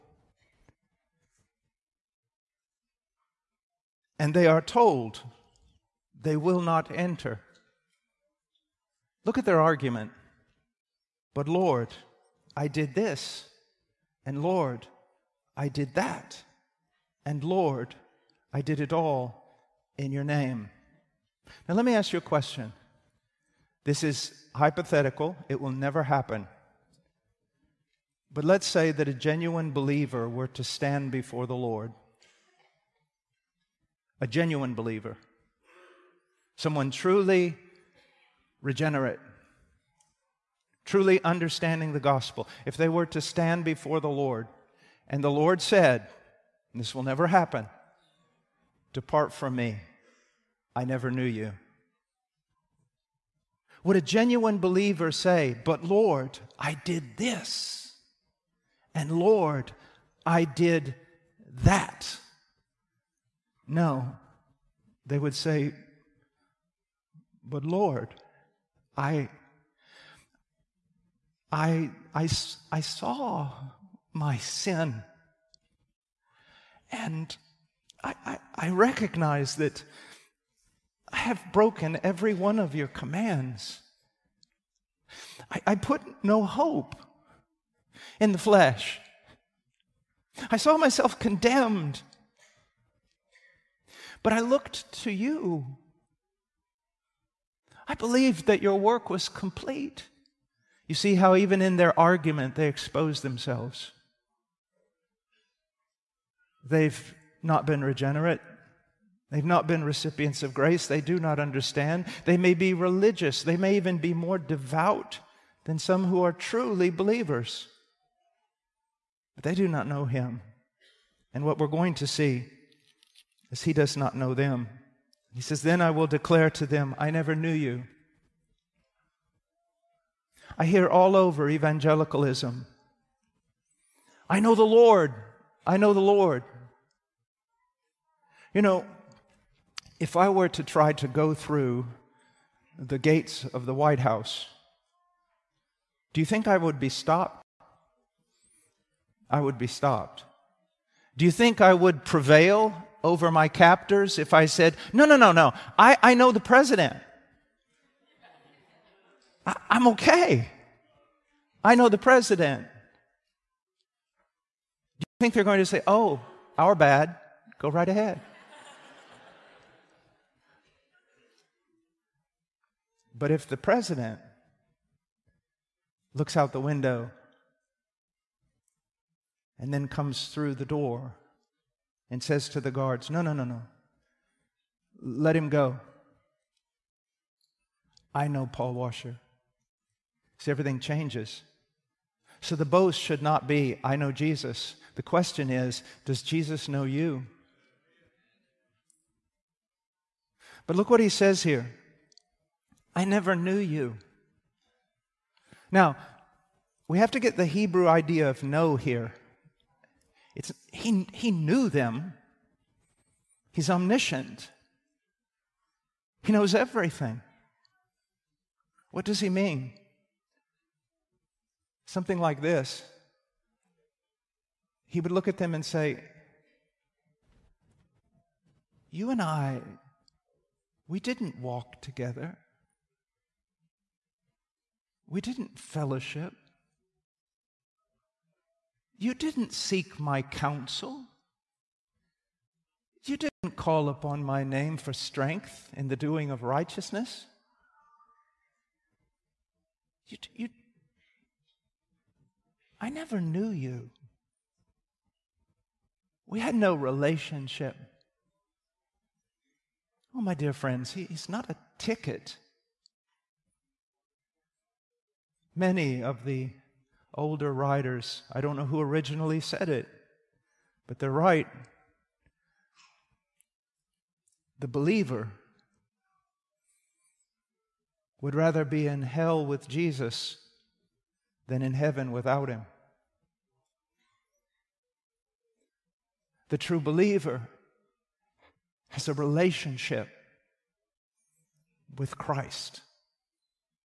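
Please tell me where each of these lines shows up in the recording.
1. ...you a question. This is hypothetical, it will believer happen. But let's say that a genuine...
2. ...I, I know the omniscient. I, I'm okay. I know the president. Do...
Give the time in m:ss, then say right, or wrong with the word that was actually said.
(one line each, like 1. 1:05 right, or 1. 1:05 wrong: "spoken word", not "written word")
1. 0:22 wrong: "never", not "believer"
2. 2:35 wrong: "president", not "omniscient".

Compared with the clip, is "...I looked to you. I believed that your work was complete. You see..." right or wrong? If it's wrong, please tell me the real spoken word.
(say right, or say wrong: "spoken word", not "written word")
right.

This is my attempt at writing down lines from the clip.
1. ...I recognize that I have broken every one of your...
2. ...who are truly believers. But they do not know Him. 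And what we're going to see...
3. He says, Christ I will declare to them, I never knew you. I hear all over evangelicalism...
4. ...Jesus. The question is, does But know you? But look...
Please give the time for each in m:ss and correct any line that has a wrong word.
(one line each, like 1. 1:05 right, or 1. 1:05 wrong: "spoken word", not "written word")
1. 1:18 right
2. 1:56 right
3. 2:05 wrong: "Then", not "Christ"
4. 3:14 wrong: "Jesus", not "But".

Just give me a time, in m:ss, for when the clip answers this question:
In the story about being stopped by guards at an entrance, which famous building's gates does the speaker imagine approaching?
2:23.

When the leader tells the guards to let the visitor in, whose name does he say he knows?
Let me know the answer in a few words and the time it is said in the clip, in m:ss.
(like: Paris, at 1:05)
Paul Washer, at 3:08.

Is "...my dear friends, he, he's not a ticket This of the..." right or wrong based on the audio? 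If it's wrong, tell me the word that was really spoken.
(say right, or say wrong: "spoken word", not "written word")
wrong: "Many", not "This".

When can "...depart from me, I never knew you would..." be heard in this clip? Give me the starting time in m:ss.
0:48.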